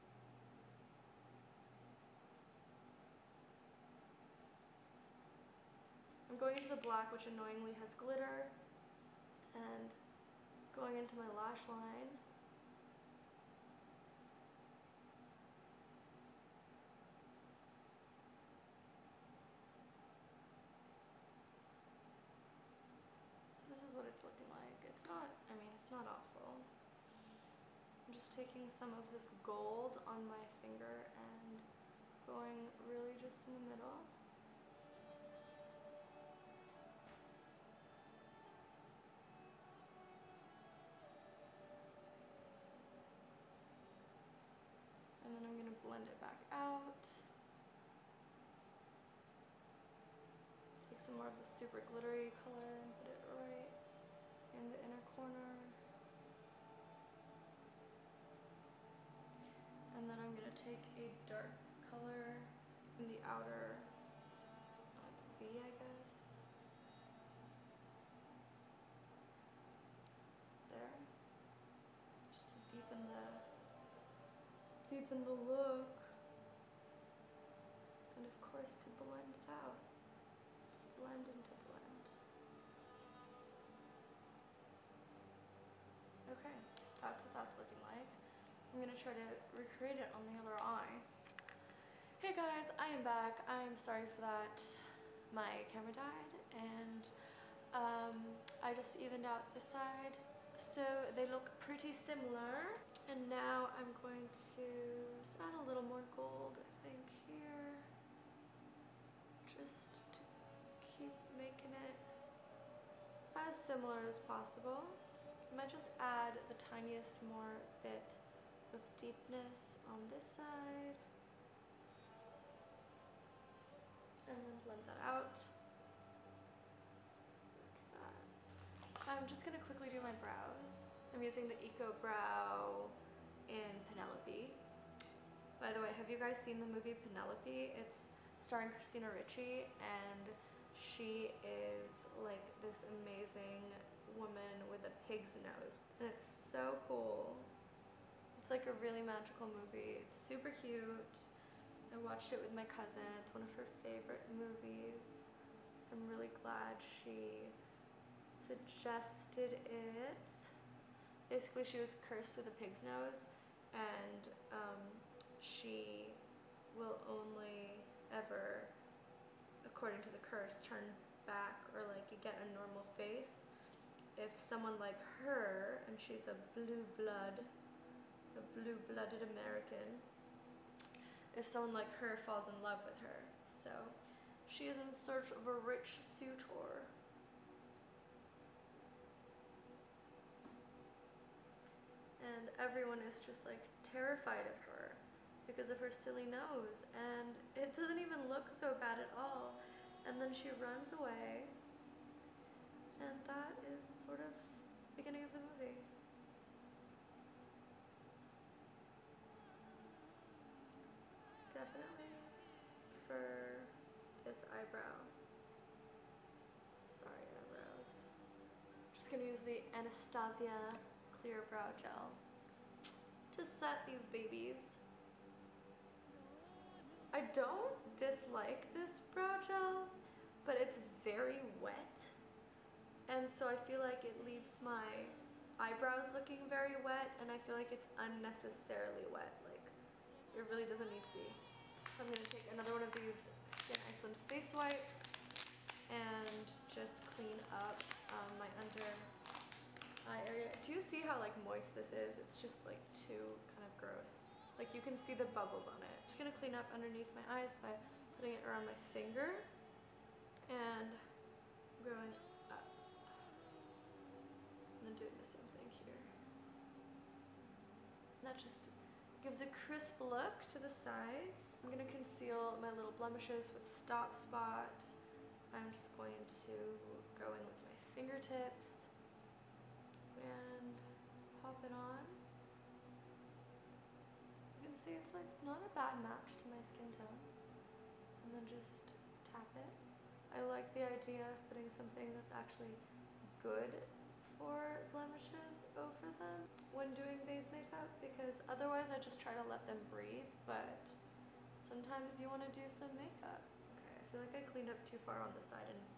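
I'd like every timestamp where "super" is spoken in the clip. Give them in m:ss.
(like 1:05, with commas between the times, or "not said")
0:51, 2:30.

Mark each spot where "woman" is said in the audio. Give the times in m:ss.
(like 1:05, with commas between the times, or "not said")
2:24.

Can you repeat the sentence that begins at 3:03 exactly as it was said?
So she is in search of a rich suitor.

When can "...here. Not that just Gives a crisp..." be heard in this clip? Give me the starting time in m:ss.
4:25.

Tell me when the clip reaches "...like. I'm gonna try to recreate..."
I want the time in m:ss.
1:27.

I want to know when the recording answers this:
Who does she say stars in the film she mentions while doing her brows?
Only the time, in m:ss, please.
2:18.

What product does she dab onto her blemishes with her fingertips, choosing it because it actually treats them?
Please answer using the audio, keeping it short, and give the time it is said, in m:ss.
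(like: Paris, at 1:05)
Stop Spot, at 4:33.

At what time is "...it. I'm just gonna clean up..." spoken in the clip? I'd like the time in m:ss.
4:15.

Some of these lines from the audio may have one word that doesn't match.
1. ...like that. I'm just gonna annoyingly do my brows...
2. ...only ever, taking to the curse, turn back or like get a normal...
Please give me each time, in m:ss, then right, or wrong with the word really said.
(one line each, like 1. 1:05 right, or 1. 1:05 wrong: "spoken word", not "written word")
1. 2:07 wrong: "quickly", not "annoyingly"
2. 2:47 wrong: "according", not "taking".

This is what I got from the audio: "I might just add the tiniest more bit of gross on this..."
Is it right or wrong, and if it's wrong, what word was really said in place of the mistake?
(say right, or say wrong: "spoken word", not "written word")
wrong: "deepness", not "gross".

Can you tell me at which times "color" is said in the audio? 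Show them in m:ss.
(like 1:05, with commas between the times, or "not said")
0:52, 1:01.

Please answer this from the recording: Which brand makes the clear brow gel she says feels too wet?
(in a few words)
Anastasia.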